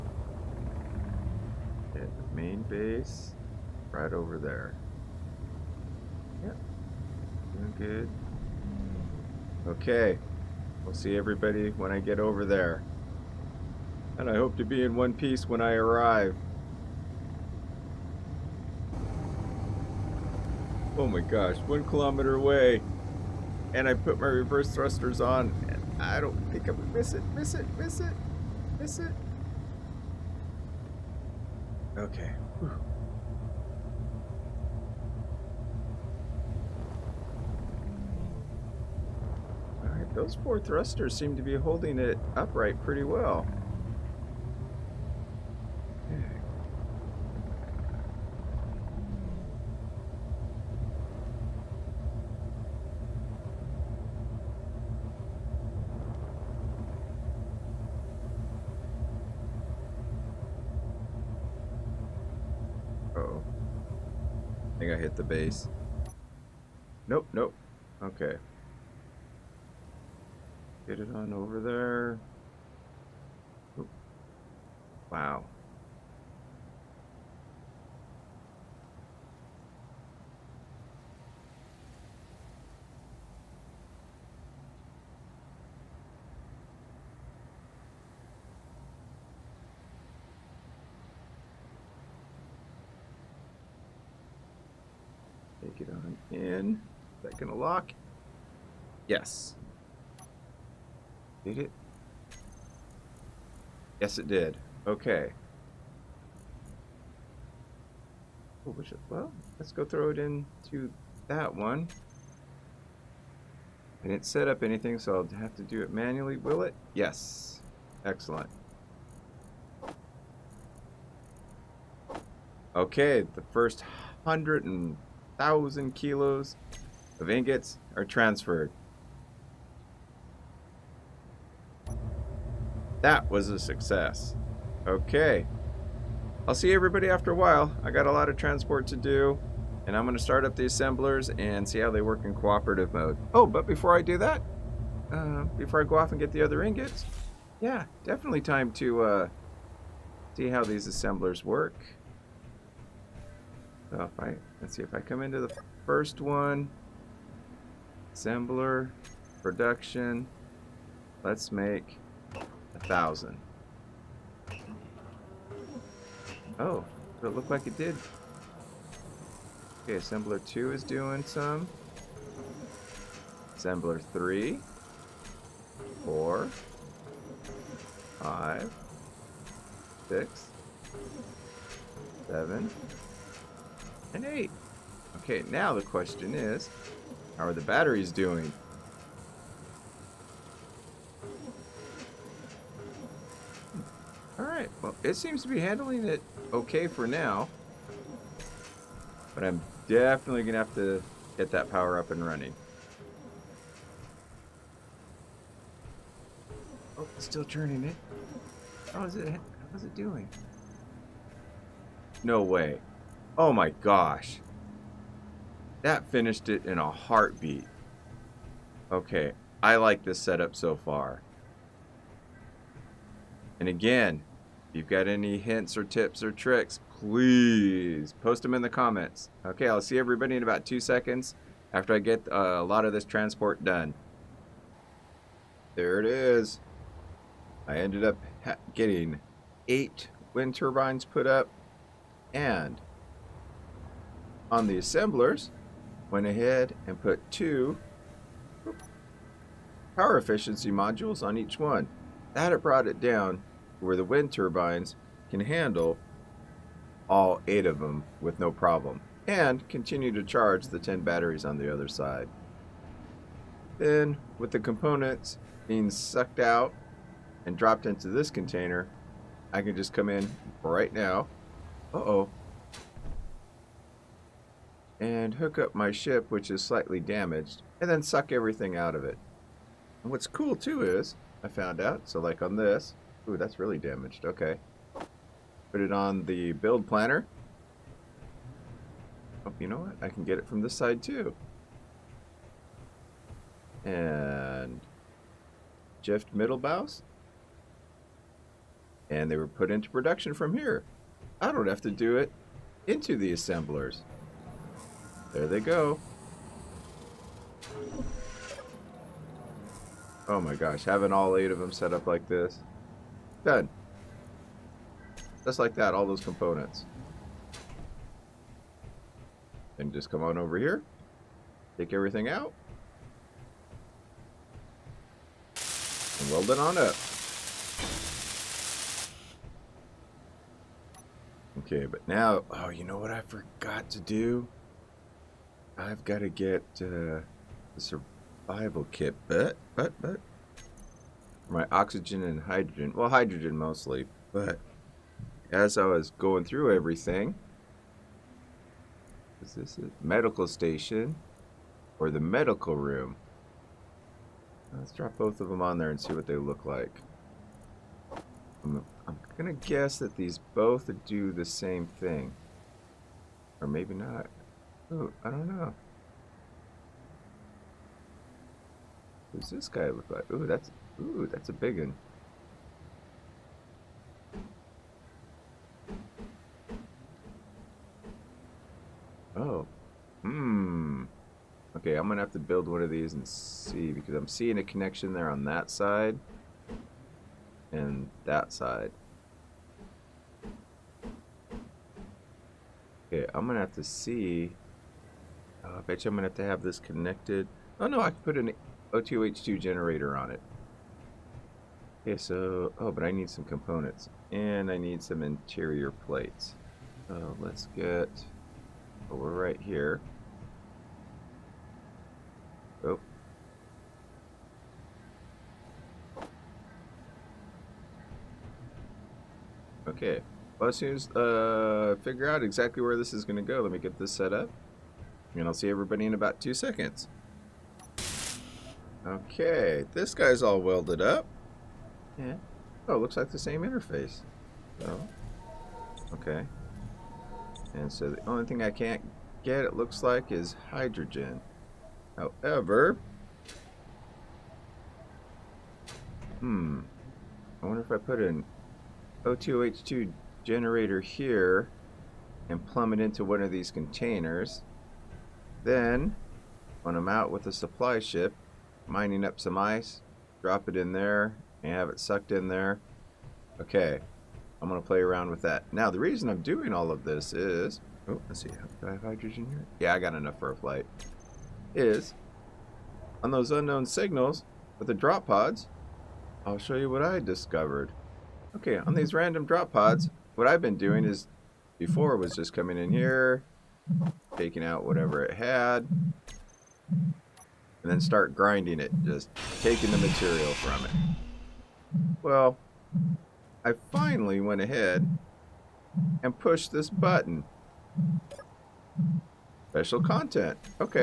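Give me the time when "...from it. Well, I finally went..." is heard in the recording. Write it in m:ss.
8:10.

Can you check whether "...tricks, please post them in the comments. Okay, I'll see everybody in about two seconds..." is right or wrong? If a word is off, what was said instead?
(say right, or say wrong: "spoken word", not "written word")
right.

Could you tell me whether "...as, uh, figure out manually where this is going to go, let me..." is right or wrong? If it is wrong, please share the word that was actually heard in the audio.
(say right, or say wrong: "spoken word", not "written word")
wrong: "exactly", not "manually".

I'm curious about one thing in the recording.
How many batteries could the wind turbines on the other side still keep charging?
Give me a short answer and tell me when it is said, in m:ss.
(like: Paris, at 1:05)
10, at 4:20.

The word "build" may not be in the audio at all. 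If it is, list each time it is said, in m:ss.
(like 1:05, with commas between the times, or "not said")
4:46, 6:22.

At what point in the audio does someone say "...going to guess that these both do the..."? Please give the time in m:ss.
5:59.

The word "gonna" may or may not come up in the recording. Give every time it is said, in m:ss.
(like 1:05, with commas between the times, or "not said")
1:37, 6:22, 6:33.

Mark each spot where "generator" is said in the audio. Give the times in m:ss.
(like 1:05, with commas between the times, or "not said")
6:39, 7:30.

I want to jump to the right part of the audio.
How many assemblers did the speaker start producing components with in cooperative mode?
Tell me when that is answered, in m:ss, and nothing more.
3:04.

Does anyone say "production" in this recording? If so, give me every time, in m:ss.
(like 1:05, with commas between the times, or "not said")
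2:39, 4:59.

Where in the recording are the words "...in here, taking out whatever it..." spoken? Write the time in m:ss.
8:02.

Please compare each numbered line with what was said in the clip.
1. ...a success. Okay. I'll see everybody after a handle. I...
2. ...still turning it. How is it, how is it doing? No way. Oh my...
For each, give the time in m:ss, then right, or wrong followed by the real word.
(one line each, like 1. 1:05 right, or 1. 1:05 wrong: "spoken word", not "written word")
1. 2:13 wrong: "while", not "handle"
2. 3:27 right.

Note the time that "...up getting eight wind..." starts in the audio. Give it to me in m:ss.
3:58.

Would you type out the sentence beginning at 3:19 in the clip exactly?
But I'm definitely going to have to get that power up and running.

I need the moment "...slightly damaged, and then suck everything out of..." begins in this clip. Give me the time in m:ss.
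4:36.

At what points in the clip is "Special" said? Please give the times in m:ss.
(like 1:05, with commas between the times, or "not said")
8:19.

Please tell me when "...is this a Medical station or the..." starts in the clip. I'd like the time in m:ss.
5:49.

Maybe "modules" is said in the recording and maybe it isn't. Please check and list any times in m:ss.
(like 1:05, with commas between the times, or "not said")
4:10.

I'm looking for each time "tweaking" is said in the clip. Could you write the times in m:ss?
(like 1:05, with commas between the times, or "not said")
not said.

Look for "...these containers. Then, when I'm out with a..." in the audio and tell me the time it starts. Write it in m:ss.
7:33.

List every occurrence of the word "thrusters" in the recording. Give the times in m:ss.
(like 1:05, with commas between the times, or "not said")
0:24, 0:40.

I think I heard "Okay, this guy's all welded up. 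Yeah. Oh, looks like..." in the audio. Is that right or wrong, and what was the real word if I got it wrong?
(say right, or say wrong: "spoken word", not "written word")
right.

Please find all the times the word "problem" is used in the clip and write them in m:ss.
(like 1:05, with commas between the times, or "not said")
4:18.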